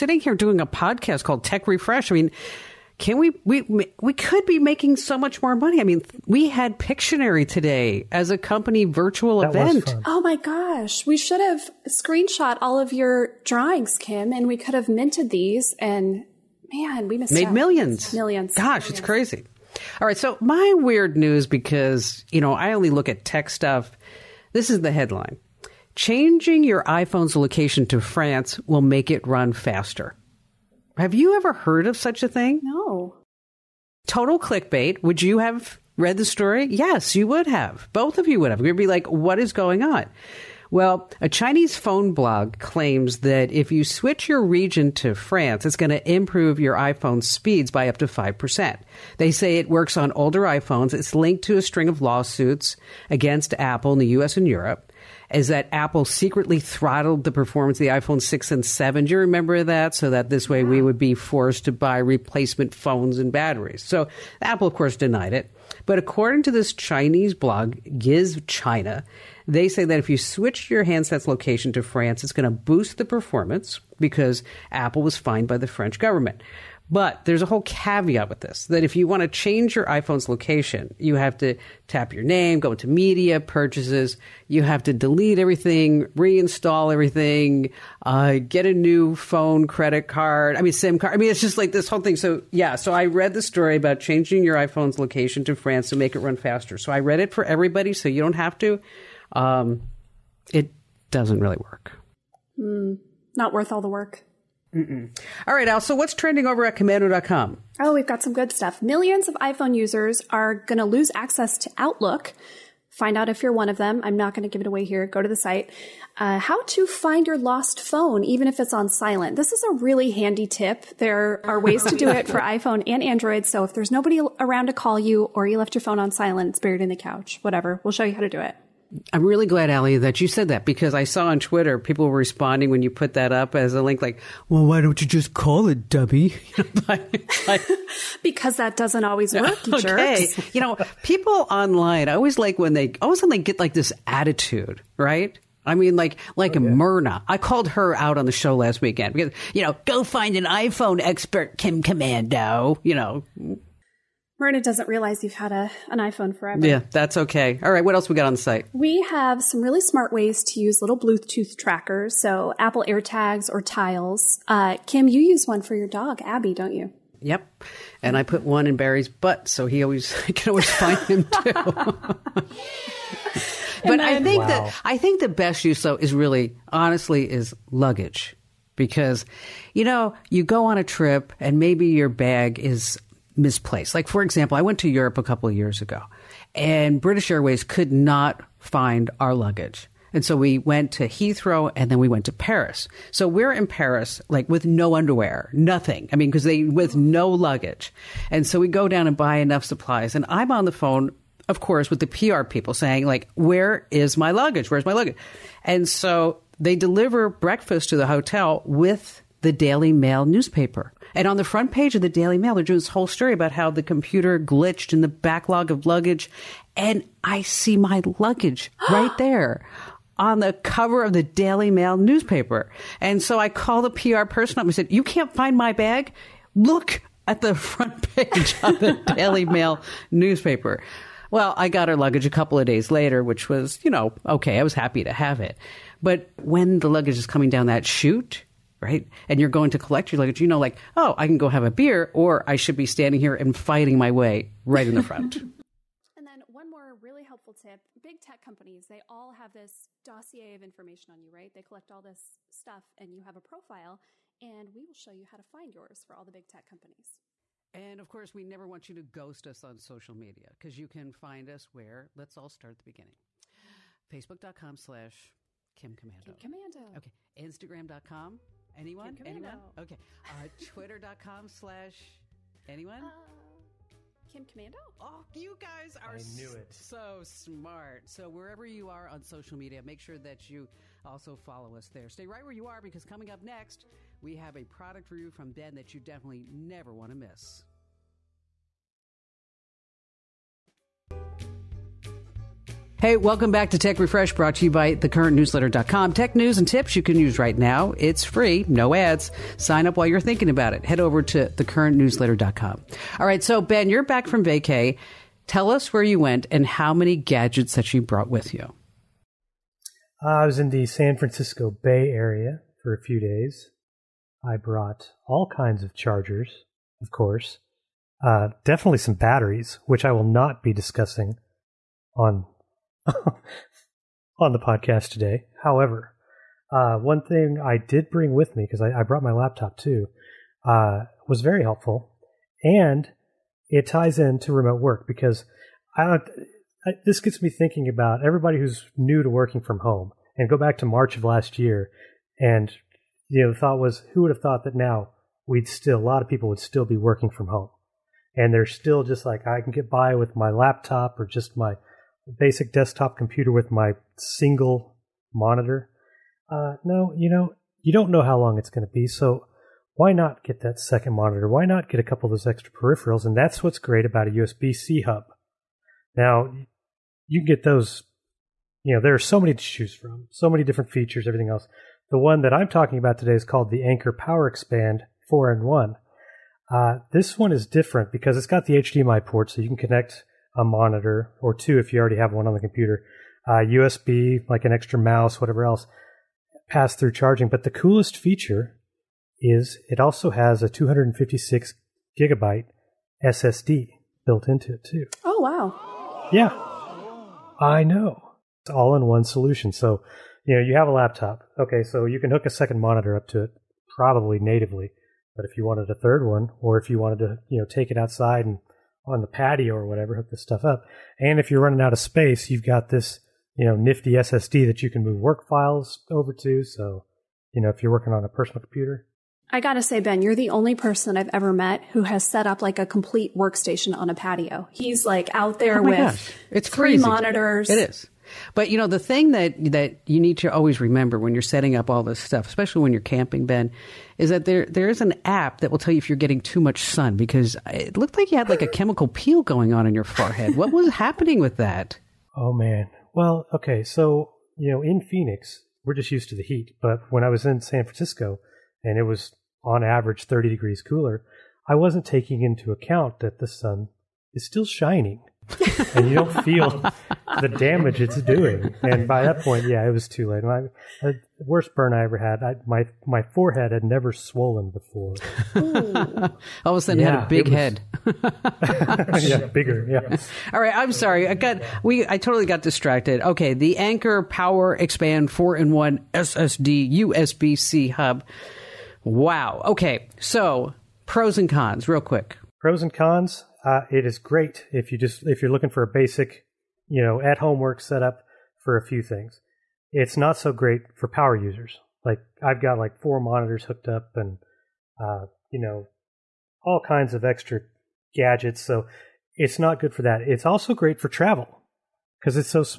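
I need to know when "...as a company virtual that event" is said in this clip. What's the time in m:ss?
0:08.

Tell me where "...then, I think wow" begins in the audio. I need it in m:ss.
2:53.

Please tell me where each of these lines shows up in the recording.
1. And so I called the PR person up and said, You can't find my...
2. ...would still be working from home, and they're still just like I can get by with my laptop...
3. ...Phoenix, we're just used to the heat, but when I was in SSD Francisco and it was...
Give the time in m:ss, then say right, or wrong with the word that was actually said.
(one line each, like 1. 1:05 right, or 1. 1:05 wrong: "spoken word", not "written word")
1. 3:43 right
2. 5:46 right
3. 7:25 wrong: "San", not "SSD".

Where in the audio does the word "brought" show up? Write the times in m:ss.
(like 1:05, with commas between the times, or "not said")
4:54, 5:08, 5:14, 5:29.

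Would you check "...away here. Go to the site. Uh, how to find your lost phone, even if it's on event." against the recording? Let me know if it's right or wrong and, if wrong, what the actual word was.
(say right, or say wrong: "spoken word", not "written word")
wrong: "silent", not "event".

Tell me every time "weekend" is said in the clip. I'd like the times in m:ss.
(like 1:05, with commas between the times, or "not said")
2:28.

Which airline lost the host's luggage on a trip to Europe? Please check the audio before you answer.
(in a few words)
British Airways.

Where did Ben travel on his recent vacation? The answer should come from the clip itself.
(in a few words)
San Francisco Bay Area.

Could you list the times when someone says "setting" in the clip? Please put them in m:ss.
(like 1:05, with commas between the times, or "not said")
7:11.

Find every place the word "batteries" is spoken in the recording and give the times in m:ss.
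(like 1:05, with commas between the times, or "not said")
1:03, 5:19.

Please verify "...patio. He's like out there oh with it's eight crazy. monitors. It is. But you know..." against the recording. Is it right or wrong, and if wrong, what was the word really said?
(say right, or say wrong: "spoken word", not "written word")
wrong: "three", not "eight".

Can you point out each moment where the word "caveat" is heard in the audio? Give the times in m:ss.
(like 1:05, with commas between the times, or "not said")
1:17.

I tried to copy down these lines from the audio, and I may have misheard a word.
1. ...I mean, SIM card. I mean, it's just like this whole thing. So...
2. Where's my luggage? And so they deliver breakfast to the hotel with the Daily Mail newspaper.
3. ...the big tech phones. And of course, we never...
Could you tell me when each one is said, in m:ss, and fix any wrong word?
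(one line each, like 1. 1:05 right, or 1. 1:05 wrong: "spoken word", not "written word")
1. 1:30 right
2. 3:24 right
3. 4:16 wrong: "companies", not "phones".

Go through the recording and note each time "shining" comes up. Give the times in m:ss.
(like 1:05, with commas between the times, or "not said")
7:34.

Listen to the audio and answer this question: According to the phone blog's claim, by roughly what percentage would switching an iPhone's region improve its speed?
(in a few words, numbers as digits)
5%.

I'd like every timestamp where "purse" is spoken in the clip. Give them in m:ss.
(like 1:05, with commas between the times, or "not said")
not said.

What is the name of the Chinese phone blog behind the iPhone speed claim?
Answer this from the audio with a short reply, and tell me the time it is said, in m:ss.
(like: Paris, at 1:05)
Gizchina, at 1:07.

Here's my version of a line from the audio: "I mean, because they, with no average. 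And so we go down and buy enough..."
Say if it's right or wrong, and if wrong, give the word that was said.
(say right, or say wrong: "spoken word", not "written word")
wrong: "luggage", not "average".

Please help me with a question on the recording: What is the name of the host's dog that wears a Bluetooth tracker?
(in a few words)
Abby.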